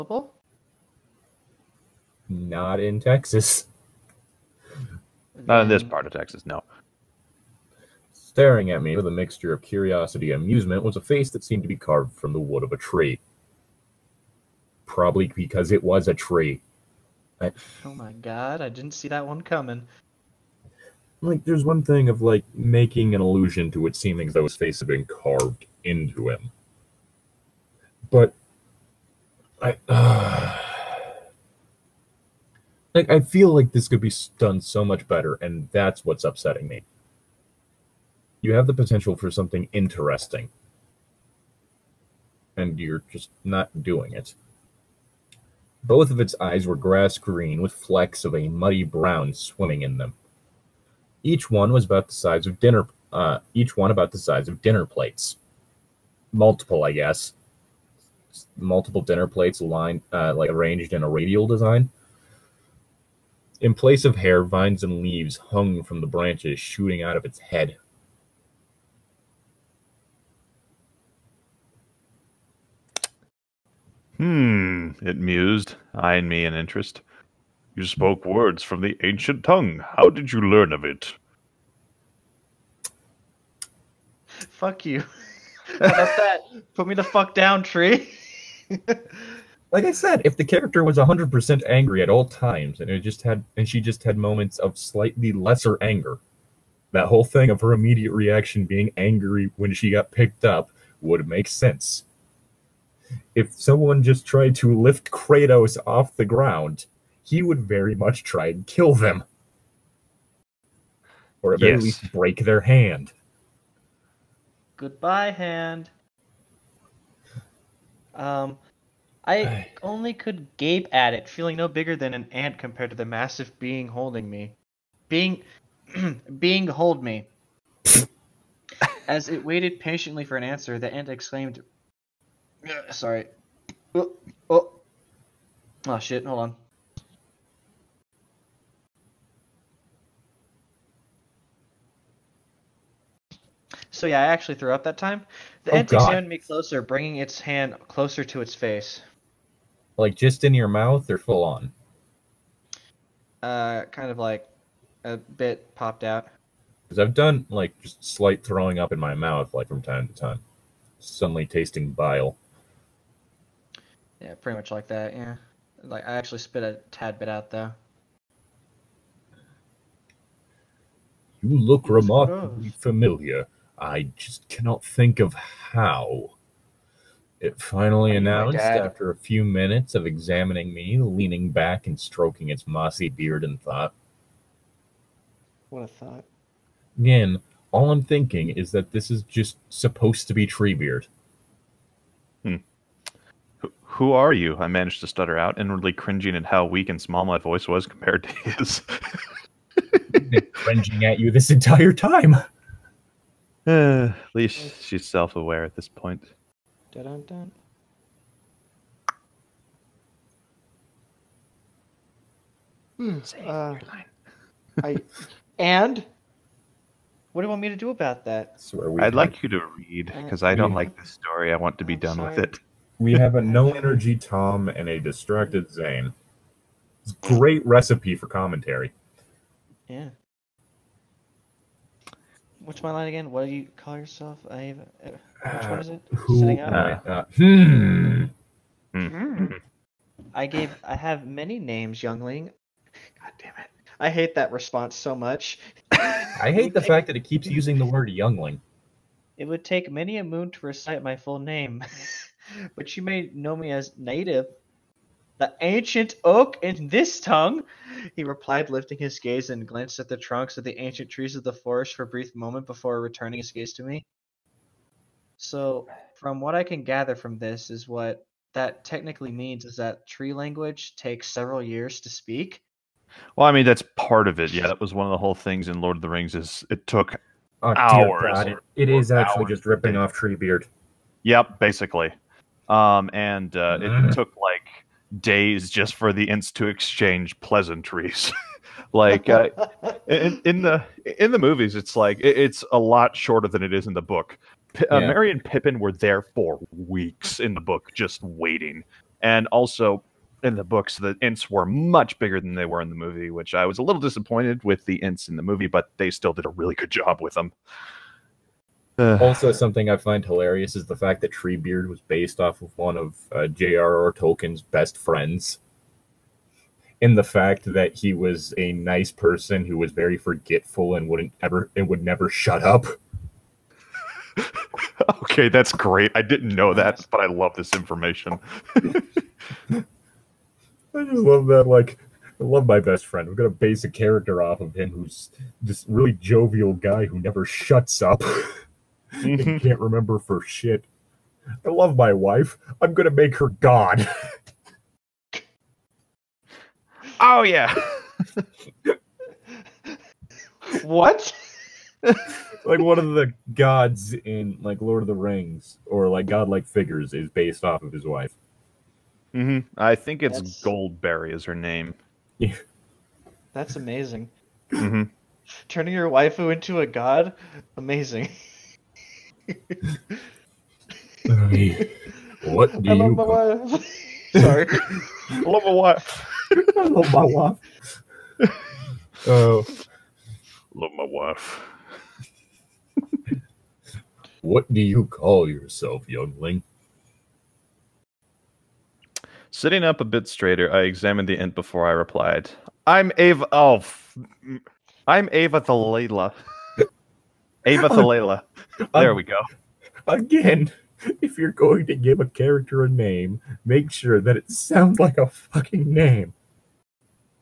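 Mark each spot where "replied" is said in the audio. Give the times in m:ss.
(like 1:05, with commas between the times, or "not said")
4:18, 6:31.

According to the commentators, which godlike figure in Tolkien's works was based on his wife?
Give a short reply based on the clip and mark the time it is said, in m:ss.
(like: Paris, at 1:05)
Goldberry, at 6:00.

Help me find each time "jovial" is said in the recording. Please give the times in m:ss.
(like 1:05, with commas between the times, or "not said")
5:36.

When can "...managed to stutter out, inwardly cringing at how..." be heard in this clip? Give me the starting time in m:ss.
3:14.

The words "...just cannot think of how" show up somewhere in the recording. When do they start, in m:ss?
2:54.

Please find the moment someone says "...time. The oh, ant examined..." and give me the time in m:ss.
2:24.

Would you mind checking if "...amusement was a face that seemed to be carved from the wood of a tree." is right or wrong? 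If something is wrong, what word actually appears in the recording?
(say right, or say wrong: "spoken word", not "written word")
right.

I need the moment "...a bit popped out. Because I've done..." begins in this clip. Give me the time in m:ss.
2:35.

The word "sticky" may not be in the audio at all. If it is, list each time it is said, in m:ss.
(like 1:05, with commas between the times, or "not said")
not said.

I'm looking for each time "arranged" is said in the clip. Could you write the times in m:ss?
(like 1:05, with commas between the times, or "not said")
1:00.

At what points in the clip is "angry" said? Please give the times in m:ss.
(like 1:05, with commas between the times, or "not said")
1:31, 1:38.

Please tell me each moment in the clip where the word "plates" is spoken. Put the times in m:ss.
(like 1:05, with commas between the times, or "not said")
0:54, 0:59.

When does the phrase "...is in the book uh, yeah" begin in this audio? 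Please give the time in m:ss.
4:53.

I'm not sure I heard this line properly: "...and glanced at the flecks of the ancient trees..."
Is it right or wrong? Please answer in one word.
wrong.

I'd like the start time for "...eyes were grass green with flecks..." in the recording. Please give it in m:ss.
0:46.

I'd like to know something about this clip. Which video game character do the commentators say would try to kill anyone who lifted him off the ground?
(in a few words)
Kratos.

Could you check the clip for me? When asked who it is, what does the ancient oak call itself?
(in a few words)
Native.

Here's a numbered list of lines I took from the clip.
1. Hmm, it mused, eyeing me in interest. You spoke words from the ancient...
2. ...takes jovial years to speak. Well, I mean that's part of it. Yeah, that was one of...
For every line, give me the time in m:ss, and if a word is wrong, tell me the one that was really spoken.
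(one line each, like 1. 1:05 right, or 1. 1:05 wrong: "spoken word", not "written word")
1. 1:14 right
2. 4:30 wrong: "several", not "jovial".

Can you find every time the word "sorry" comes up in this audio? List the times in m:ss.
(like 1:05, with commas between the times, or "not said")
2:12, 3:42, 6:14.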